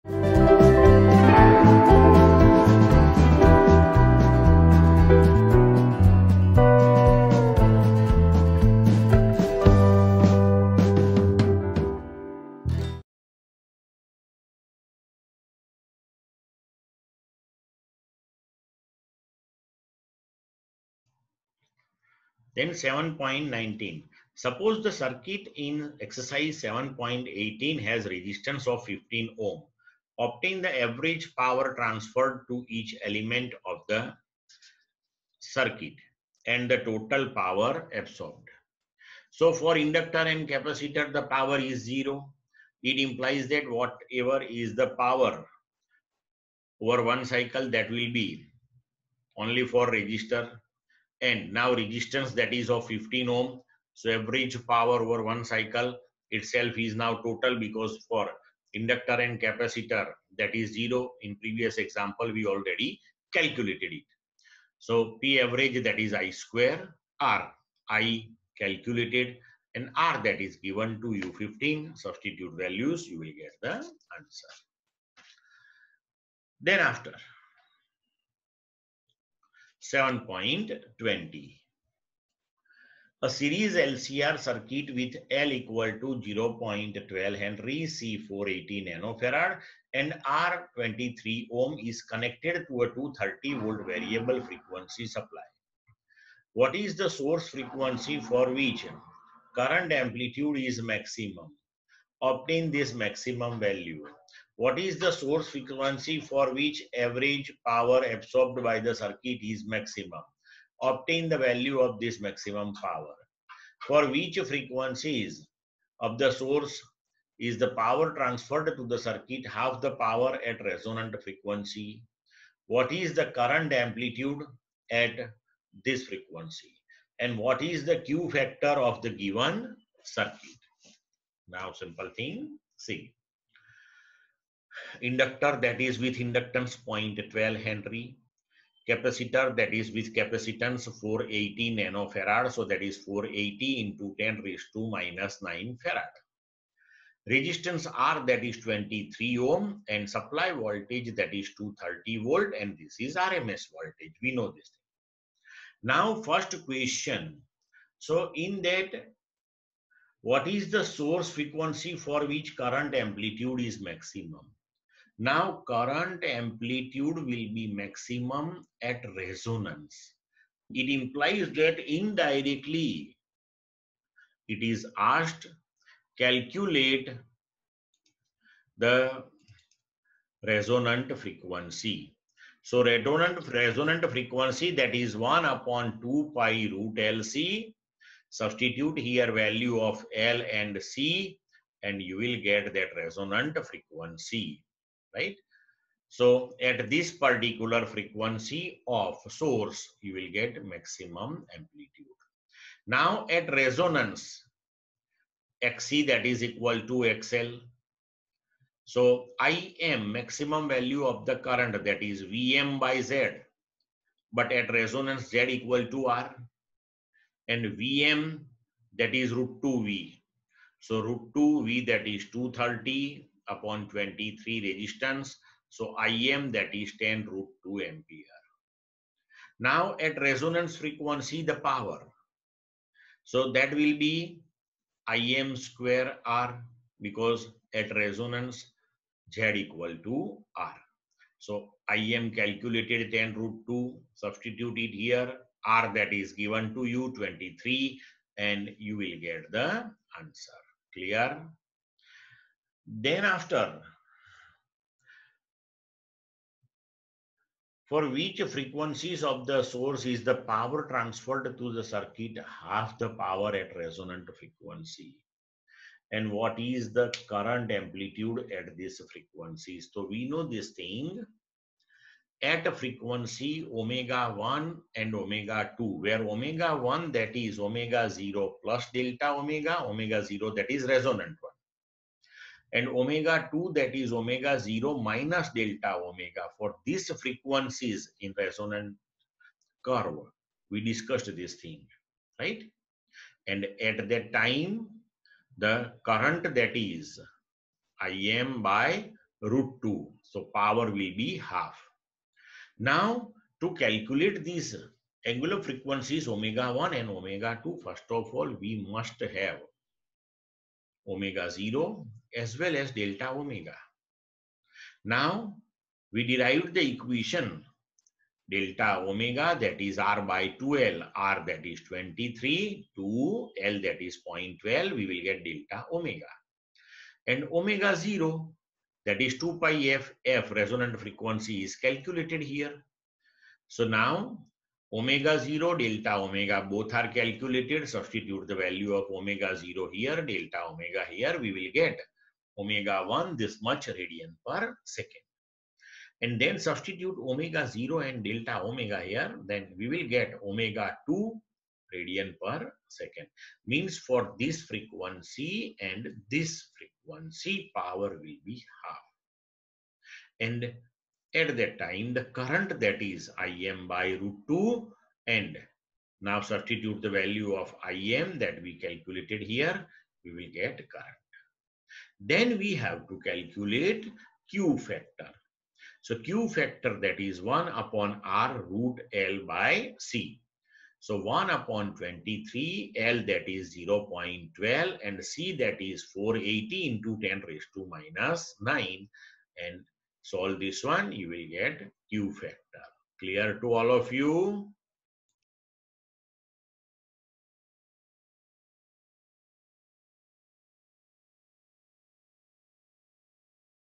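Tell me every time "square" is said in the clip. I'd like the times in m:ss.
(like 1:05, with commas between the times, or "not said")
1:06, 3:55.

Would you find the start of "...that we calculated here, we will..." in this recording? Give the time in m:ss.
6:08.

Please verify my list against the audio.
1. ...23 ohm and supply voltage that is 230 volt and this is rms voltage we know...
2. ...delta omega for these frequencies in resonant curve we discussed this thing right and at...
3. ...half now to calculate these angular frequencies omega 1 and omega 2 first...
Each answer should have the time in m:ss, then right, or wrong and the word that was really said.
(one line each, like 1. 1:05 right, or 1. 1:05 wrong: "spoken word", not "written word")
1. 2:28 right
2. 4:45 right
3. 5:01 right.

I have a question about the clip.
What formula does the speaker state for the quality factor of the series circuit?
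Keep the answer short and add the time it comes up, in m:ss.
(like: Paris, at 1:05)
1/R root(L/C), at 6:17.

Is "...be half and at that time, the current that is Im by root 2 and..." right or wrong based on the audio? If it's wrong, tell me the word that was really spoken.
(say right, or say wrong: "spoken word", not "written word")
right.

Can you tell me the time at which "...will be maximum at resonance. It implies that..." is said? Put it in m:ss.
2:47.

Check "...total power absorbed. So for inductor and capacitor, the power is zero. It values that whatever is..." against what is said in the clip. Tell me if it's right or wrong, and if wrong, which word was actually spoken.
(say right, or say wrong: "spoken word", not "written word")
wrong: "implies", not "values".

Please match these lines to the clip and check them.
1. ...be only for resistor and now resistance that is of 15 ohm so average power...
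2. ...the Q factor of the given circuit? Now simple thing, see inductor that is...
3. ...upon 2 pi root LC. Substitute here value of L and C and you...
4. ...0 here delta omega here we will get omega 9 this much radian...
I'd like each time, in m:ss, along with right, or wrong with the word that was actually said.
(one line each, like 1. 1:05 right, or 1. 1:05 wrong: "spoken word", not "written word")
1. 0:48 right
2. 2:07 right
3. 3:05 right
4. 5:39 wrong: "1", not "9".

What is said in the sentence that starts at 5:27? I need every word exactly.
And omega 0 that is 2 pi f, f resonant frequency is calculated here.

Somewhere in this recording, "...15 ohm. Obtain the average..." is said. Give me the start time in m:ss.
0:28.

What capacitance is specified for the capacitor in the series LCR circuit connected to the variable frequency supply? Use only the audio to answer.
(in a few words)
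480 nanofarad.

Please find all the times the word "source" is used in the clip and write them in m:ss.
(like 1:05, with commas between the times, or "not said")
1:37, 1:45, 1:56, 2:40, 3:19, 4:19.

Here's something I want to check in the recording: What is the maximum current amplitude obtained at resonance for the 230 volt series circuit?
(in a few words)
10 root 2 ampere.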